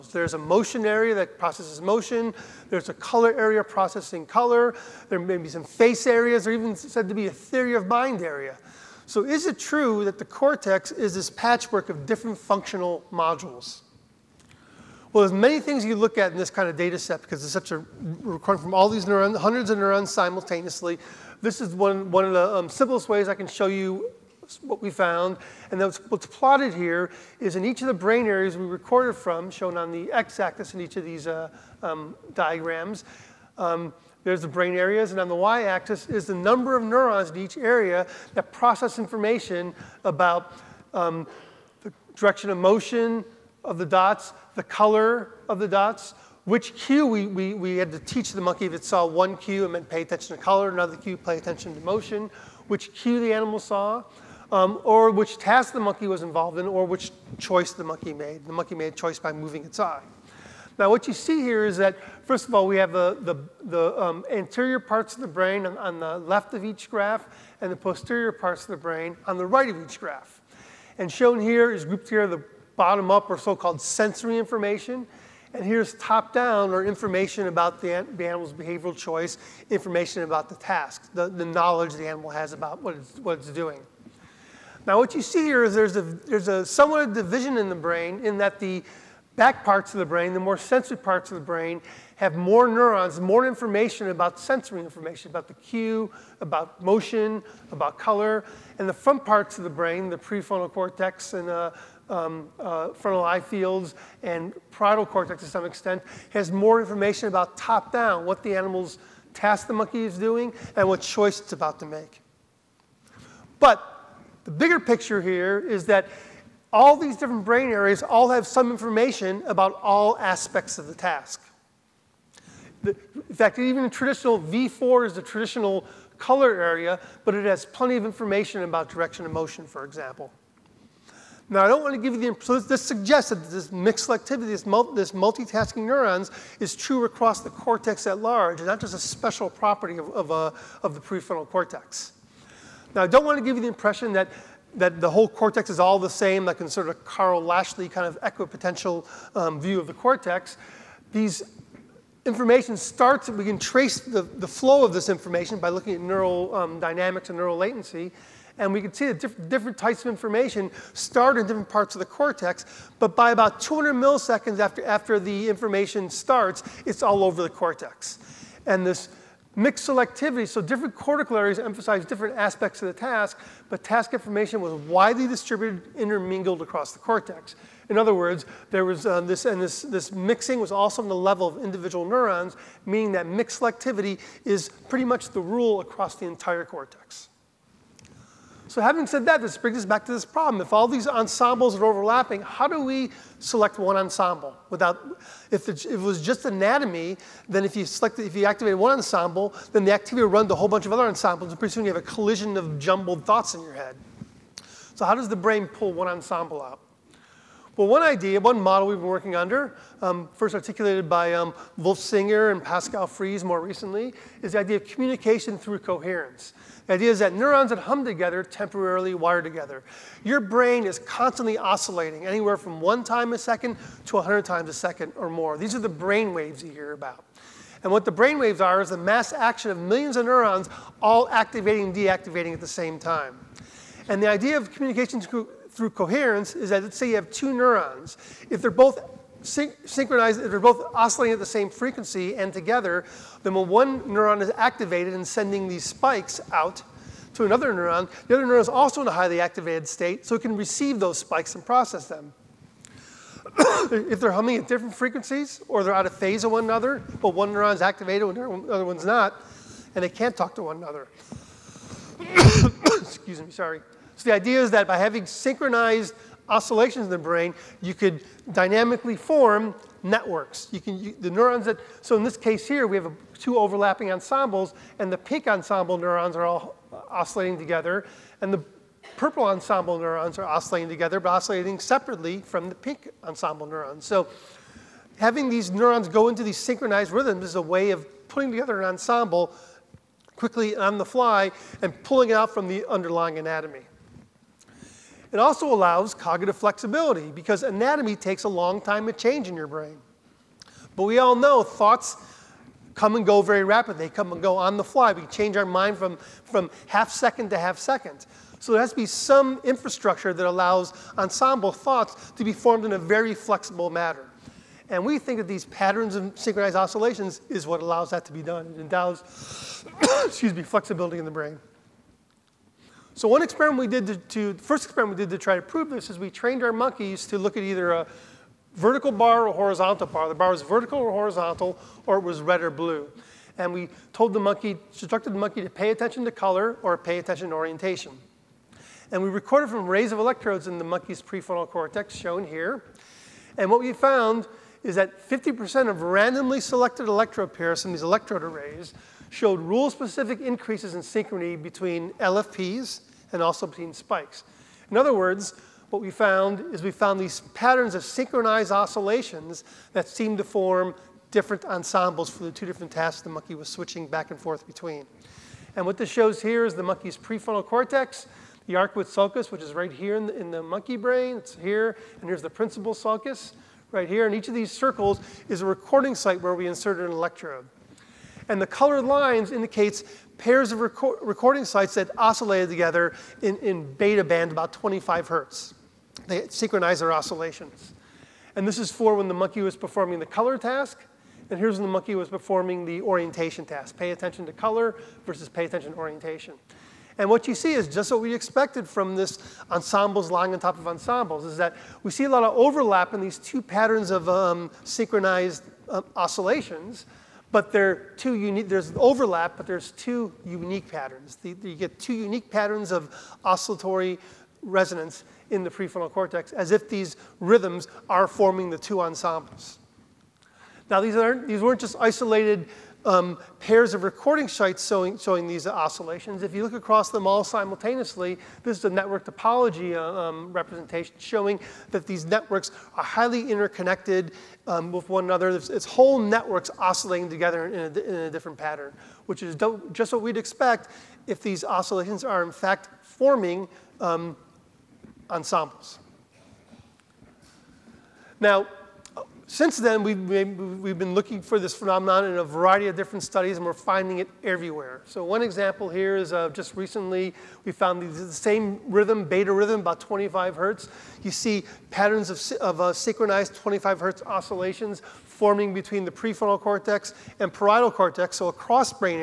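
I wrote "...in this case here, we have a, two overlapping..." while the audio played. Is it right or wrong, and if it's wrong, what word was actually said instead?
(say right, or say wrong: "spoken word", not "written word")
right.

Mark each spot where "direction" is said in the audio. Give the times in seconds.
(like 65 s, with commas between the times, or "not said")
42 s, 128 s.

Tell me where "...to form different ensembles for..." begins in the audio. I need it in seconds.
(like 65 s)
360 s.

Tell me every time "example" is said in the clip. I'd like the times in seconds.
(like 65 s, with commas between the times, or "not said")
129 s, 455 s.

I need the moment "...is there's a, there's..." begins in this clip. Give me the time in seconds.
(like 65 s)
85 s.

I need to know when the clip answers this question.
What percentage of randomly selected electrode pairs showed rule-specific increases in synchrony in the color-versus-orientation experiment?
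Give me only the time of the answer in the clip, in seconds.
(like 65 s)
345 s.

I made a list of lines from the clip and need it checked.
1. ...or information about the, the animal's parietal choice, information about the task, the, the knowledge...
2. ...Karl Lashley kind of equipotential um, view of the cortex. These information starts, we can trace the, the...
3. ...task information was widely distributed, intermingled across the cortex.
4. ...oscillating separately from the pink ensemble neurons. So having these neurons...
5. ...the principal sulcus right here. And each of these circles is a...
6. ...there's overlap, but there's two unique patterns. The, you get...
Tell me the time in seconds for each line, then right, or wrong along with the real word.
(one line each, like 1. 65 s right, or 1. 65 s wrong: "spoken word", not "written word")
1. 76 s wrong: "behavioral", not "parietal"
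2. 147 s right
3. 173 s right
4. 281 s right
5. 372 s right
6. 408 s right.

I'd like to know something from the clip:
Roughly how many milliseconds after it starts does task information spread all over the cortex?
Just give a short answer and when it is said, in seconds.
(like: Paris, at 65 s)
200, at 163 s.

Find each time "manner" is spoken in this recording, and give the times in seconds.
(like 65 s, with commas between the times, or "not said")
313 s.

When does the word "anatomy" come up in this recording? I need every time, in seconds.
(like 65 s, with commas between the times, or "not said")
196 s, 293 s, 297 s.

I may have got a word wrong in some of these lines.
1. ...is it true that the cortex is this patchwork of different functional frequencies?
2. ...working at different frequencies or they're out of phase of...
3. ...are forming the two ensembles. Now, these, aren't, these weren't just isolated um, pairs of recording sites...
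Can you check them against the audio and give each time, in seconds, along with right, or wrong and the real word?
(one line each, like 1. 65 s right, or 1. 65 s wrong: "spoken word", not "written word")
1. 9 s wrong: "modules", not "frequencies"
2. 254 s wrong: "humming", not "working"
3. 418 s right.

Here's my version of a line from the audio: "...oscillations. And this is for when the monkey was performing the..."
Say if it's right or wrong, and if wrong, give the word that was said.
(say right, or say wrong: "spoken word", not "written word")
right.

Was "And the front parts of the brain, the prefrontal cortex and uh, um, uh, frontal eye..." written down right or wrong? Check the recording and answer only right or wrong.
right.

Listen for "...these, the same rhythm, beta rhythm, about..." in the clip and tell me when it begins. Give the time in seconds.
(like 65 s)
457 s.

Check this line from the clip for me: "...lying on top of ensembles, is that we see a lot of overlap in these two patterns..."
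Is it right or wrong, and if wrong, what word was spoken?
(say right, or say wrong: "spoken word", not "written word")
right.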